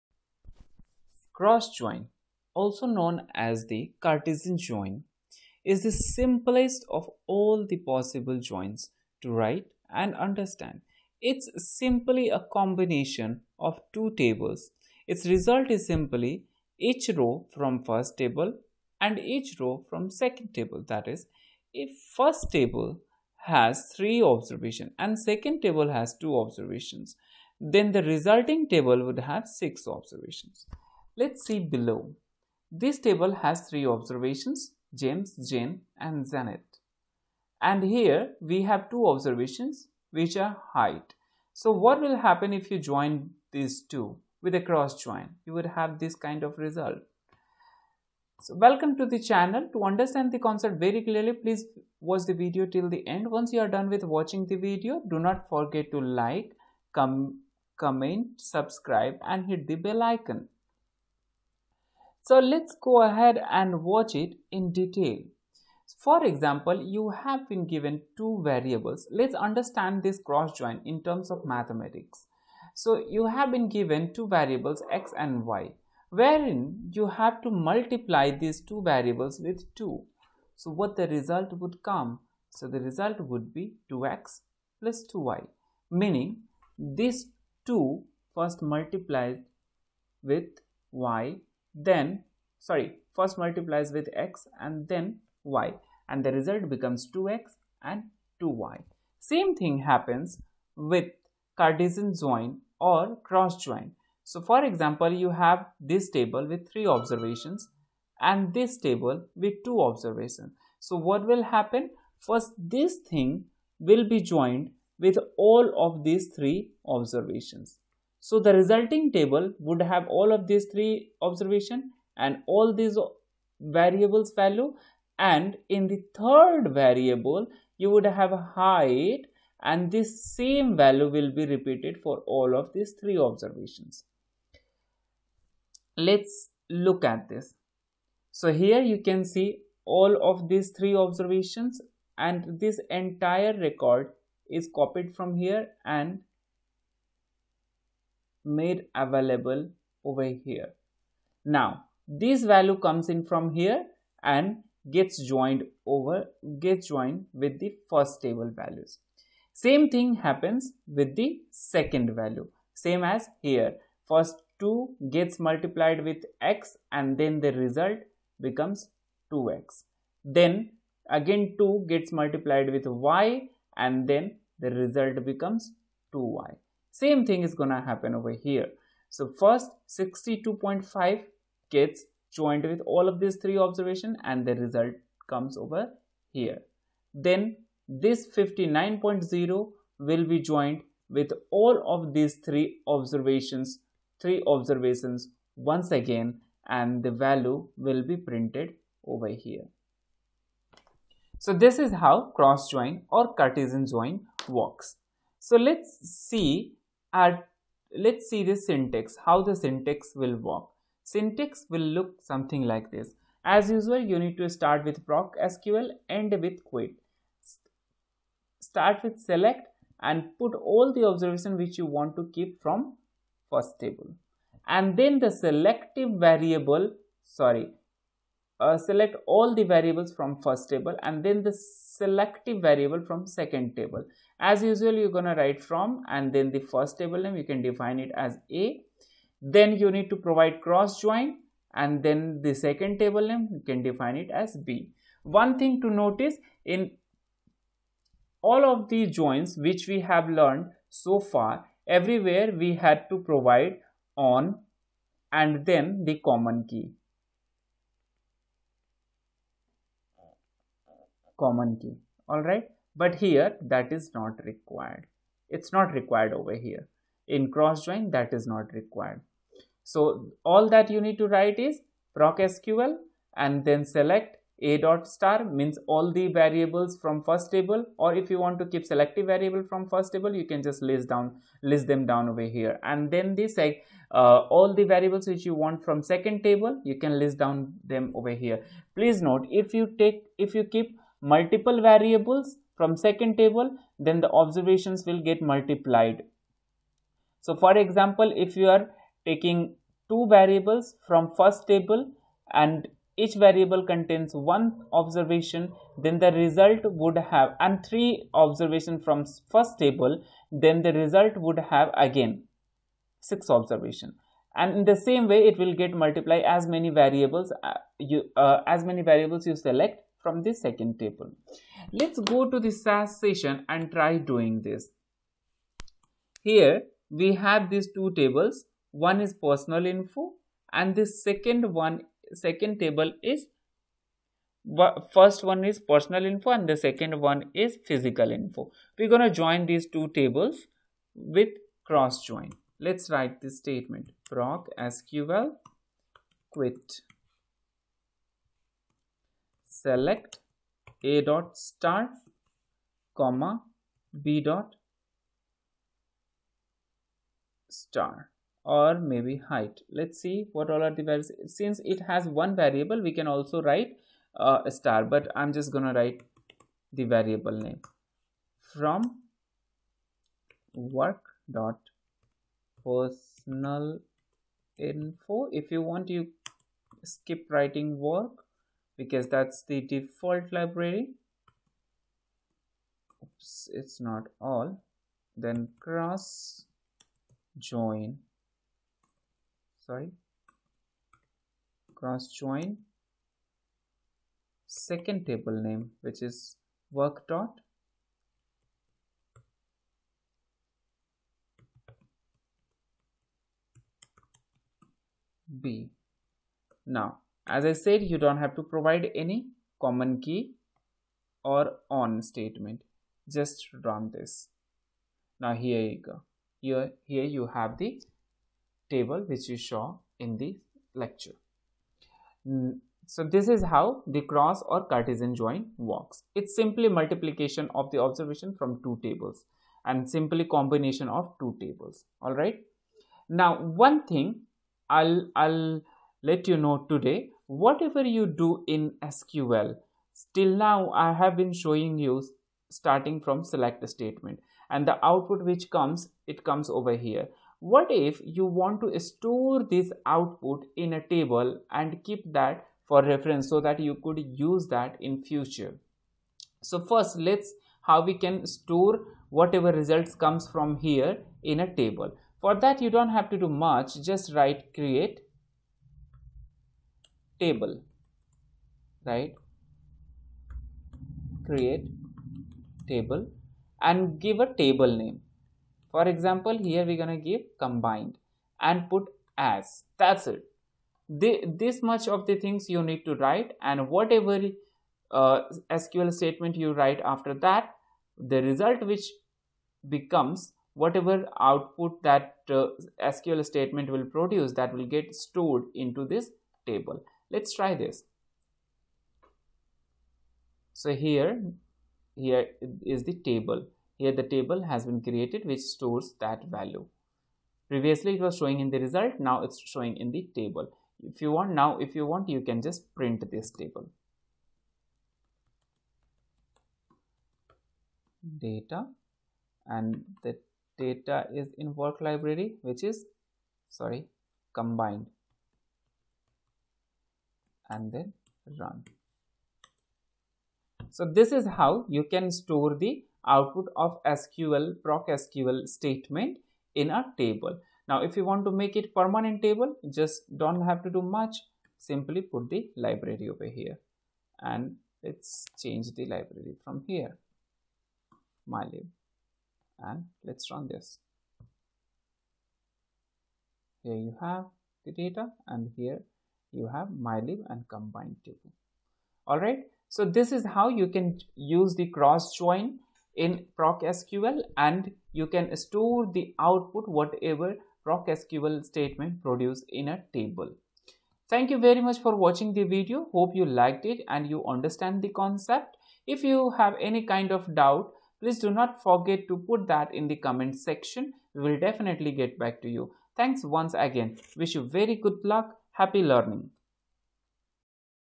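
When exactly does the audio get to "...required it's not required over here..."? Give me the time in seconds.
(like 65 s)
264 s.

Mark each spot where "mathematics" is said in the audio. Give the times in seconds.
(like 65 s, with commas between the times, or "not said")
71 s.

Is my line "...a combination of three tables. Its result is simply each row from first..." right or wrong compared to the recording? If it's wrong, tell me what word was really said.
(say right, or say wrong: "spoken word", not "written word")
wrong: "two", not "three".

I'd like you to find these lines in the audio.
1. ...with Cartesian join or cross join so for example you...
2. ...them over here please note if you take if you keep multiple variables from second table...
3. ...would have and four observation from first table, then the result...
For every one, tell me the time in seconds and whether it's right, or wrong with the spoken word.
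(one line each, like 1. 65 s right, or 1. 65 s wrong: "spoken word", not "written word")
1. 100 s right
2. 287 s right
3. 306 s wrong: "three", not "four".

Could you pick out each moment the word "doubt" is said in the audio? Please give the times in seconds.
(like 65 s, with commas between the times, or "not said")
577 s.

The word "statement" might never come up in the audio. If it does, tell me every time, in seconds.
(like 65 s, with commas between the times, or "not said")
343 s, 412 s, 443 s, 486 s, 493 s, 535 s, 568 s.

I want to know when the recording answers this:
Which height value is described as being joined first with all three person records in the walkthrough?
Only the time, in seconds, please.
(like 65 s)
179 s.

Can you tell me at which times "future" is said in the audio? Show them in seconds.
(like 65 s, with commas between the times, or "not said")
455 s.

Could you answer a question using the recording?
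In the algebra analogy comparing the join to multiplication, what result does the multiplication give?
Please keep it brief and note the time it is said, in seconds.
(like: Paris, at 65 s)
2x plus 2y, at 83 s.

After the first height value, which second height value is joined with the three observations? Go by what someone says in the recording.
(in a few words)
59.0.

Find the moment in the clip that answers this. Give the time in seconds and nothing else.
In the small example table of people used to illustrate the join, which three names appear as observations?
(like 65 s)
34 s.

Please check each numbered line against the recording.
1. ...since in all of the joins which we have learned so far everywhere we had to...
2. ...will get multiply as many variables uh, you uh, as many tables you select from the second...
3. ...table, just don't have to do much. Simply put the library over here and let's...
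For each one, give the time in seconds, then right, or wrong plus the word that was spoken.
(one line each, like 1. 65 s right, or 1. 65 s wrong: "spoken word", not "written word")
1. 245 s wrong: "notice", not "since"
2. 315 s wrong: "variables", not "tables"
3. 539 s right.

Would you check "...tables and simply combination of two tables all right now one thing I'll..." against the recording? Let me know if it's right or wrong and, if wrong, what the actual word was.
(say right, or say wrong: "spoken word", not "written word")
right.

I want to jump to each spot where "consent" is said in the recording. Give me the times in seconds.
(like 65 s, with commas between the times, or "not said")
not said.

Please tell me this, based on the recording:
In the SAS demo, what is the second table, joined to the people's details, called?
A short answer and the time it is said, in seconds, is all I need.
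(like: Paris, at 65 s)
physical info, at 337 s.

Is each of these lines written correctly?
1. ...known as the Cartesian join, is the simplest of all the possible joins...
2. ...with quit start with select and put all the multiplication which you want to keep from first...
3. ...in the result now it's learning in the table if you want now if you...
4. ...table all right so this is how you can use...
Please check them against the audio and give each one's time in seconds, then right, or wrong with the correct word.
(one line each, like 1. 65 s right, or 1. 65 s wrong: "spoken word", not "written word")
1. 2 s right
2. 216 s wrong: "observation", not "multiplication"
3. 508 s wrong: "showing", not "learning"
4. 558 s right.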